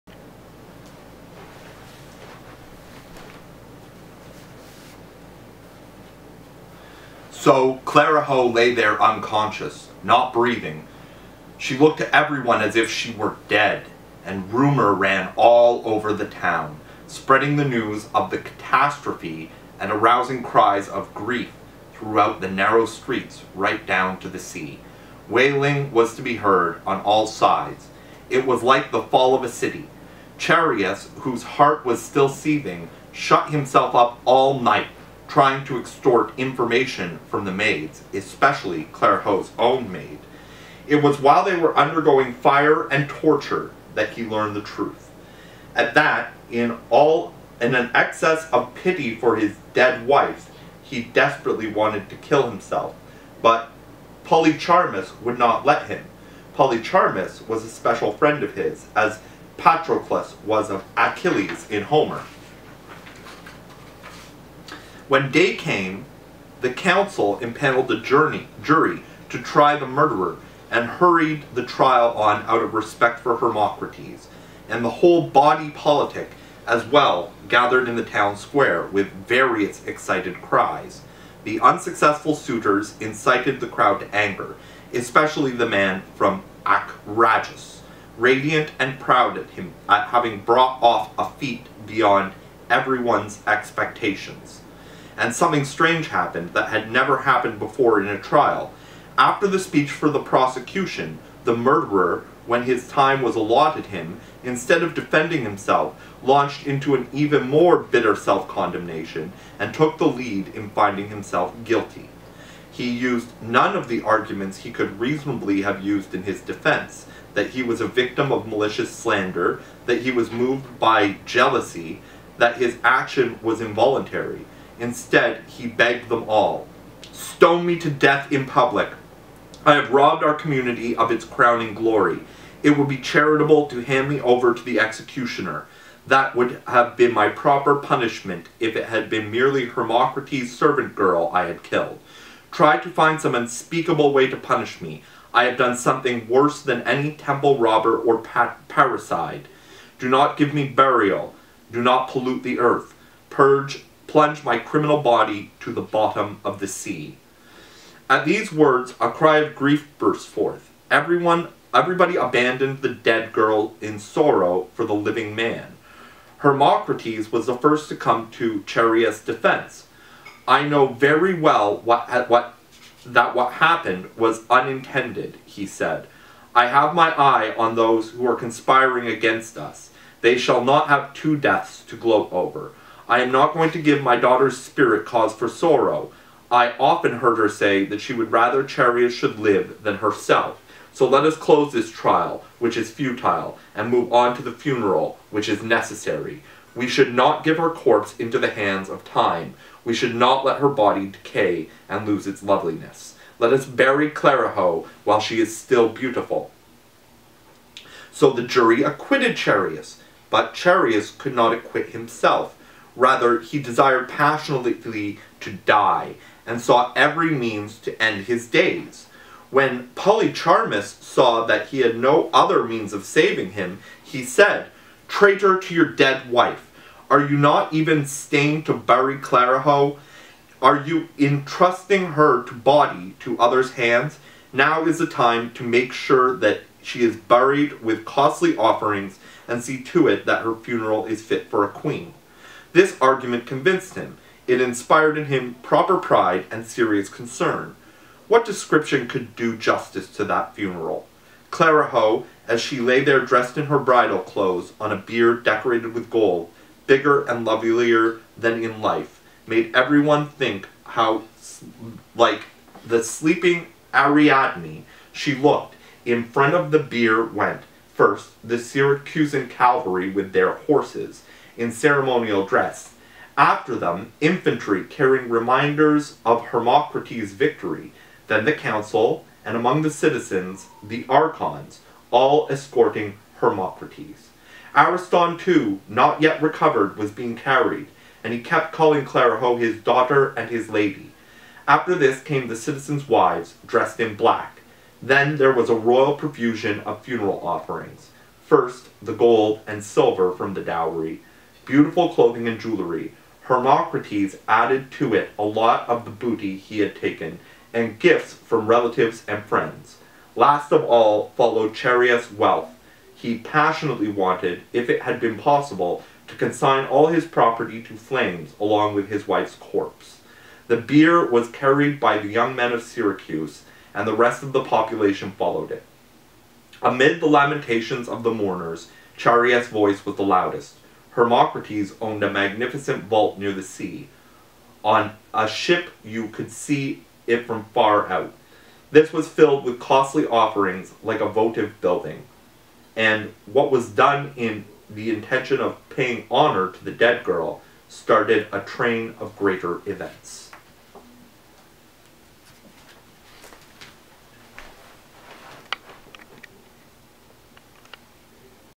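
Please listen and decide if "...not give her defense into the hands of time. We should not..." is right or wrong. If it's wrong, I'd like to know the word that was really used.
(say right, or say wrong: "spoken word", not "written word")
wrong: "corpse", not "defense".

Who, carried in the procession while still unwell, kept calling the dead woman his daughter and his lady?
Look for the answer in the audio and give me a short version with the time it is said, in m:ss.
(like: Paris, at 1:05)
Ariston, at 4:44.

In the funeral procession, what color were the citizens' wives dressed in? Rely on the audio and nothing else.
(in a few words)
Black.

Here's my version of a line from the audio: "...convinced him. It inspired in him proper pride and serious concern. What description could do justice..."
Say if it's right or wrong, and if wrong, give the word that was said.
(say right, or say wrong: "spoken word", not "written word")
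right.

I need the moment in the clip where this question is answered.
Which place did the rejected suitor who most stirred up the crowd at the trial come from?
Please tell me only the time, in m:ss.
1:26.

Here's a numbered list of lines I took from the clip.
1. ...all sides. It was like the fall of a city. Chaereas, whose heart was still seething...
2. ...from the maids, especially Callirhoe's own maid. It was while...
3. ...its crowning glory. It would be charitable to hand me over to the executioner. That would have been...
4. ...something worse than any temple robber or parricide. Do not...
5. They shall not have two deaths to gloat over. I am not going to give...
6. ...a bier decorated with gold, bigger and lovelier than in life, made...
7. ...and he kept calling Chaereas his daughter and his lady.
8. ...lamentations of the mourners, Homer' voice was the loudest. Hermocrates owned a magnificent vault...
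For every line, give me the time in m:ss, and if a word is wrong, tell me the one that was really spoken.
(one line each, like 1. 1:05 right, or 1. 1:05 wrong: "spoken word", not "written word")
1. 0:27 right
2. 0:37 right
3. 2:11 right
4. 2:25 right
5. 3:00 right
6. 4:14 right
7. 4:48 wrong: "Callirhoe", not "Chaereas"
8. 5:27 wrong: "Chaereas", not "Homer".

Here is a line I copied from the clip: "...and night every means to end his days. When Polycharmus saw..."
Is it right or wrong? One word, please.
wrong.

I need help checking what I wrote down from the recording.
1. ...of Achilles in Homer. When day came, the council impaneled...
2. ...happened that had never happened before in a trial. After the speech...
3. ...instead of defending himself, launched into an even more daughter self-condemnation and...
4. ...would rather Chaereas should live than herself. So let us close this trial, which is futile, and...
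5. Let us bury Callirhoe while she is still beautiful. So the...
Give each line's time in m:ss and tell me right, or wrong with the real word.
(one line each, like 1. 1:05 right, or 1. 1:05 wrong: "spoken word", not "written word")
1. 1:00 right
2. 1:36 right
3. 1:44 wrong: "bitter", not "daughter"
4. 3:08 right
5. 3:23 right.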